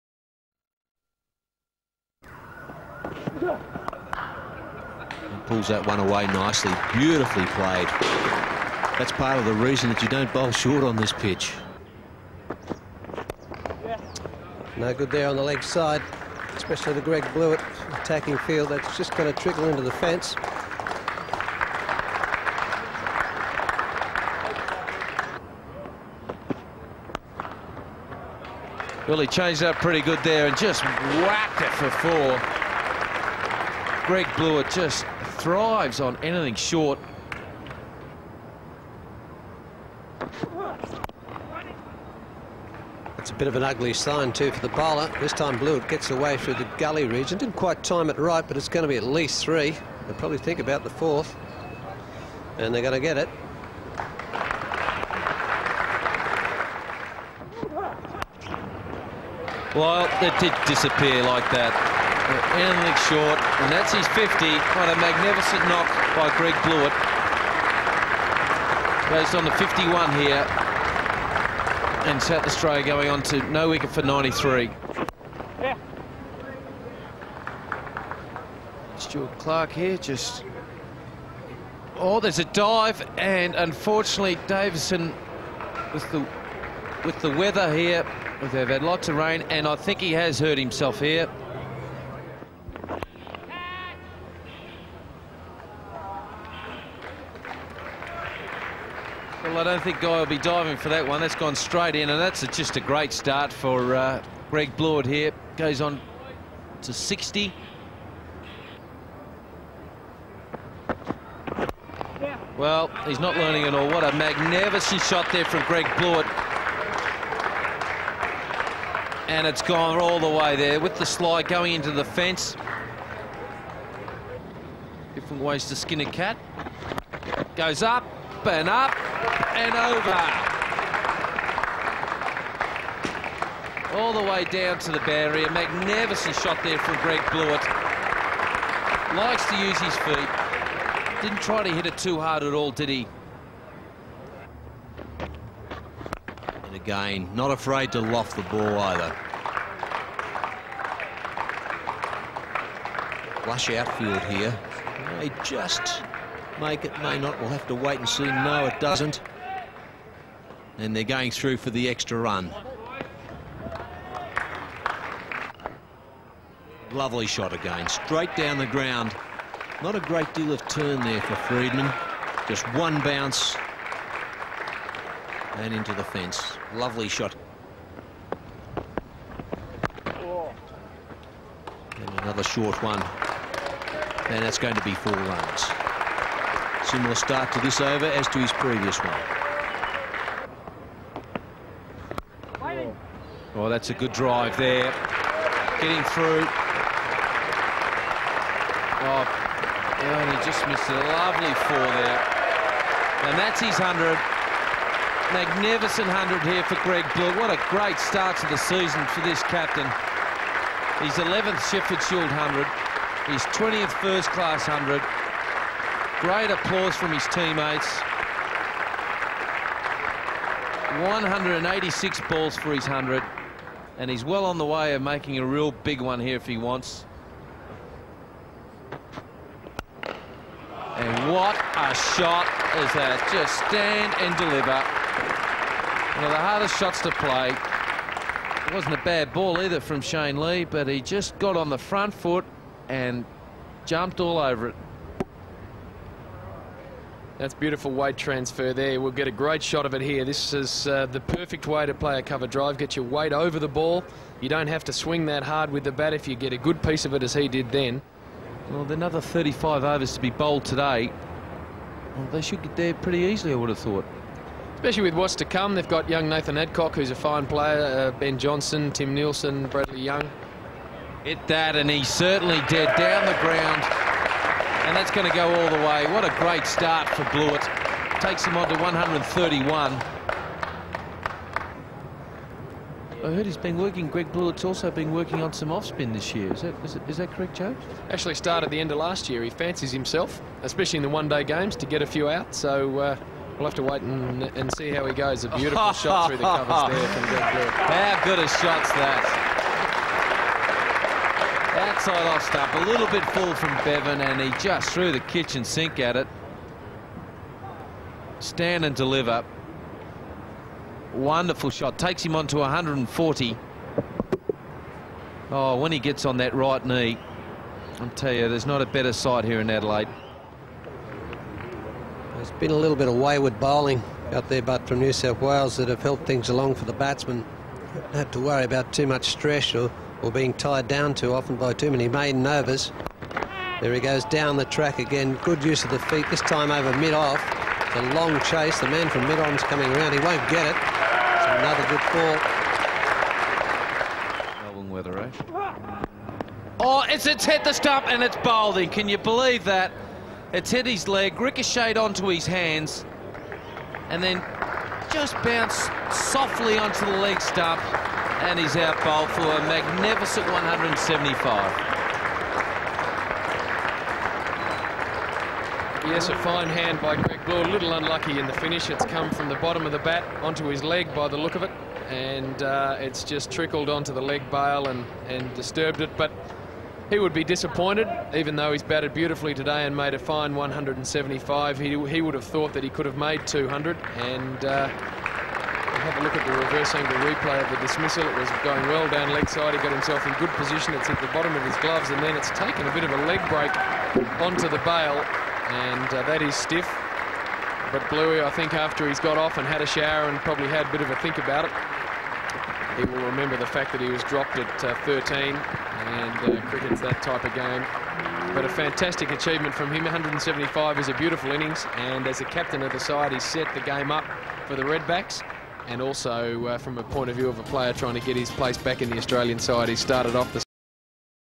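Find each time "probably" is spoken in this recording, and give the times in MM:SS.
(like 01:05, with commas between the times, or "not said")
00:50, 06:40.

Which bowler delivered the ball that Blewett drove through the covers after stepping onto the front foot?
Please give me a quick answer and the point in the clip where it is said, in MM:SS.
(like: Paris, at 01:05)
Shane Lee, at 04:00.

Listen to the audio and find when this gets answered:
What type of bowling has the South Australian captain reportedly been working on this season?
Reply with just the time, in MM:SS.
04:45.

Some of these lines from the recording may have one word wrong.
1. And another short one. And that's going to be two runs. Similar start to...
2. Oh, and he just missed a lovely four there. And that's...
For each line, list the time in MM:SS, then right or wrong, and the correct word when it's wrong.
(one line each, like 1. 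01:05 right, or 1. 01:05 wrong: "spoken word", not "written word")
1. 02:58 wrong: "four", not "two"
2. 03:19 right.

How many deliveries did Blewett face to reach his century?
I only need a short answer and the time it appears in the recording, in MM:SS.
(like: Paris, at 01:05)
186, at 03:41.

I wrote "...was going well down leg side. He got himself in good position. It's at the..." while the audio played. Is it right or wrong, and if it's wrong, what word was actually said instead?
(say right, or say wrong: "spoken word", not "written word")
right.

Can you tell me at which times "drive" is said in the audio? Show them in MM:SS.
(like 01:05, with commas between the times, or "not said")
03:14, 04:12.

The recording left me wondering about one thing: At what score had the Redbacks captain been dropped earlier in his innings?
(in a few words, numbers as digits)
13.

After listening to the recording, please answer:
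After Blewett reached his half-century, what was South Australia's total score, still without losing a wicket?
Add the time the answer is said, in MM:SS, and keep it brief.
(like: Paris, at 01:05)
93, at 01:14.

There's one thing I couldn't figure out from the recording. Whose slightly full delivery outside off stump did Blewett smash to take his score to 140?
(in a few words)
Bevan.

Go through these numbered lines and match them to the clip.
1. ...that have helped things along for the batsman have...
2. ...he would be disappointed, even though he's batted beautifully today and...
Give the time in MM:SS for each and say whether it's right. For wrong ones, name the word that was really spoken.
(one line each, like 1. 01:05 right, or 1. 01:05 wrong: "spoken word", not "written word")
1. 05:25 right
2. 06:17 right.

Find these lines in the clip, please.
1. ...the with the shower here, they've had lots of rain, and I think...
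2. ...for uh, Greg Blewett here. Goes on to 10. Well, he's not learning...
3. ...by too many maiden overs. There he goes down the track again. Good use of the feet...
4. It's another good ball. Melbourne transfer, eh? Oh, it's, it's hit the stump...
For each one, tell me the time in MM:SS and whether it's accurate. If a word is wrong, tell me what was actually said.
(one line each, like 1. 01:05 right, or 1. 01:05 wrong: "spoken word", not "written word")
1. 01:26 wrong: "weather", not "shower"
2. 01:43 wrong: "60", not "10"
3. 05:31 right
4. 05:41 wrong: "weather", not "transfer".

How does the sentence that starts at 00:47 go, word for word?
Didn't quite time it right, but it's going to be at least three.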